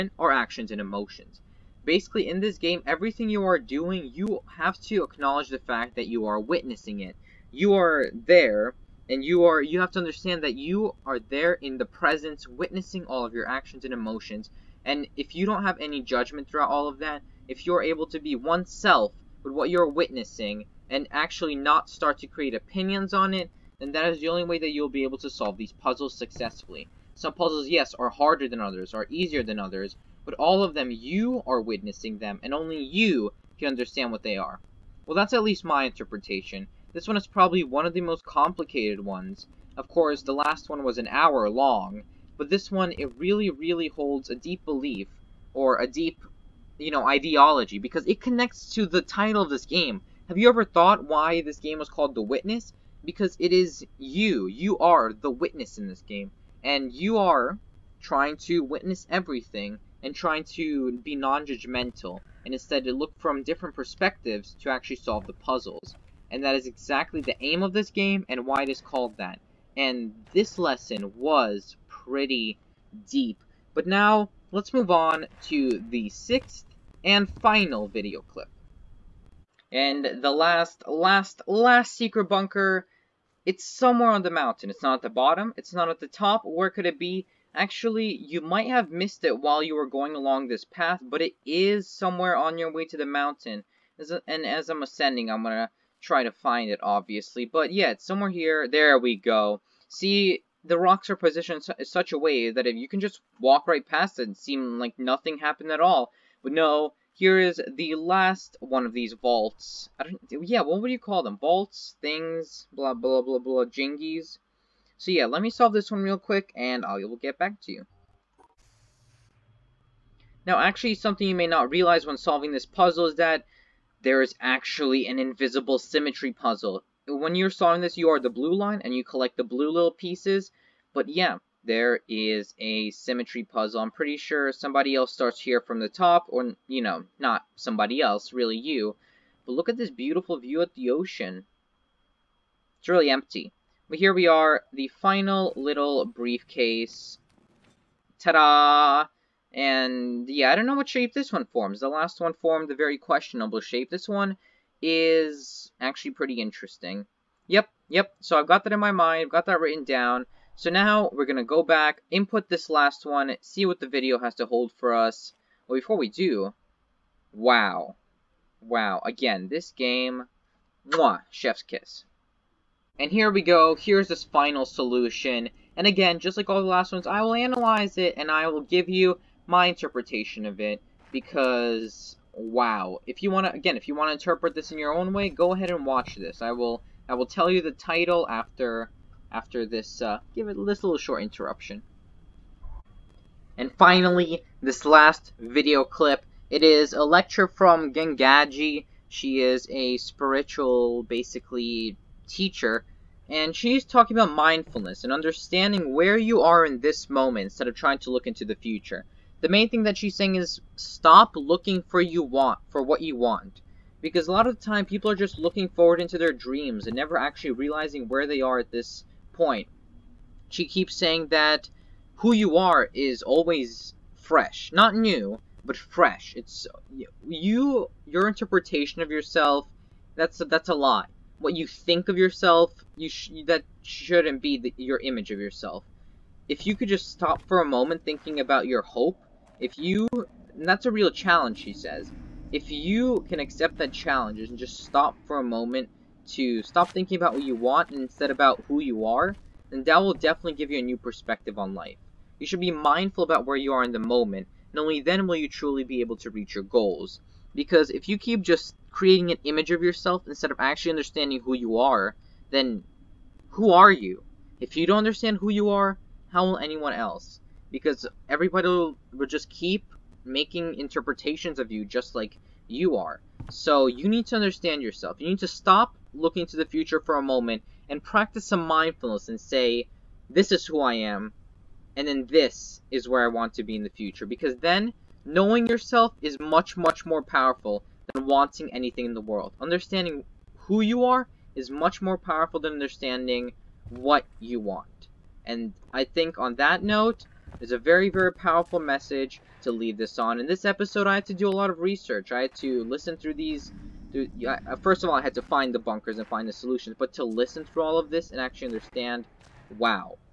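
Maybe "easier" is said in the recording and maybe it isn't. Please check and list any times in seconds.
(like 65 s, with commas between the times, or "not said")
29 s.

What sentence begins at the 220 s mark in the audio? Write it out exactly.
She keeps saying that who you are is always fresh.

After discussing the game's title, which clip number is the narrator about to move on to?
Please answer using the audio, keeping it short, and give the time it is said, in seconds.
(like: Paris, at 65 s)
6, at 76 s.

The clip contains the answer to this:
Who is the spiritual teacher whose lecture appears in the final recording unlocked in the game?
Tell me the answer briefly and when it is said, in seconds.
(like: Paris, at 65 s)
Gangaji, at 197 s.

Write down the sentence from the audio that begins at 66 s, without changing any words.
And that is exactly the aim of this game and why it is called that.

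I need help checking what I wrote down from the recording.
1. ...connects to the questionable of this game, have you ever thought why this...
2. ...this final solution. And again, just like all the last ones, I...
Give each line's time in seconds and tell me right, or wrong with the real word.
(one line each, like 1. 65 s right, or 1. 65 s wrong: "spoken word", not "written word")
1. 48 s wrong: "title", not "questionable"
2. 174 s right.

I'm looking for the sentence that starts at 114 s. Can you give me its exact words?
So yeah, let me solve this one real quick, and I will get back to you.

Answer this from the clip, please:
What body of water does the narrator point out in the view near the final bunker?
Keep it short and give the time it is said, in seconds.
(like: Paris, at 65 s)
Ocean, at 140 s.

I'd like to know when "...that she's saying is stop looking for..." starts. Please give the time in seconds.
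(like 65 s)
209 s.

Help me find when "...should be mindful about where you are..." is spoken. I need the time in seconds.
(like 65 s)
252 s.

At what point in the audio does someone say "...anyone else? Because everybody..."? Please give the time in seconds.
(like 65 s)
266 s.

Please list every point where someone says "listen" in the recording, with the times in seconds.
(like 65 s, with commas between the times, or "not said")
302 s, 307 s.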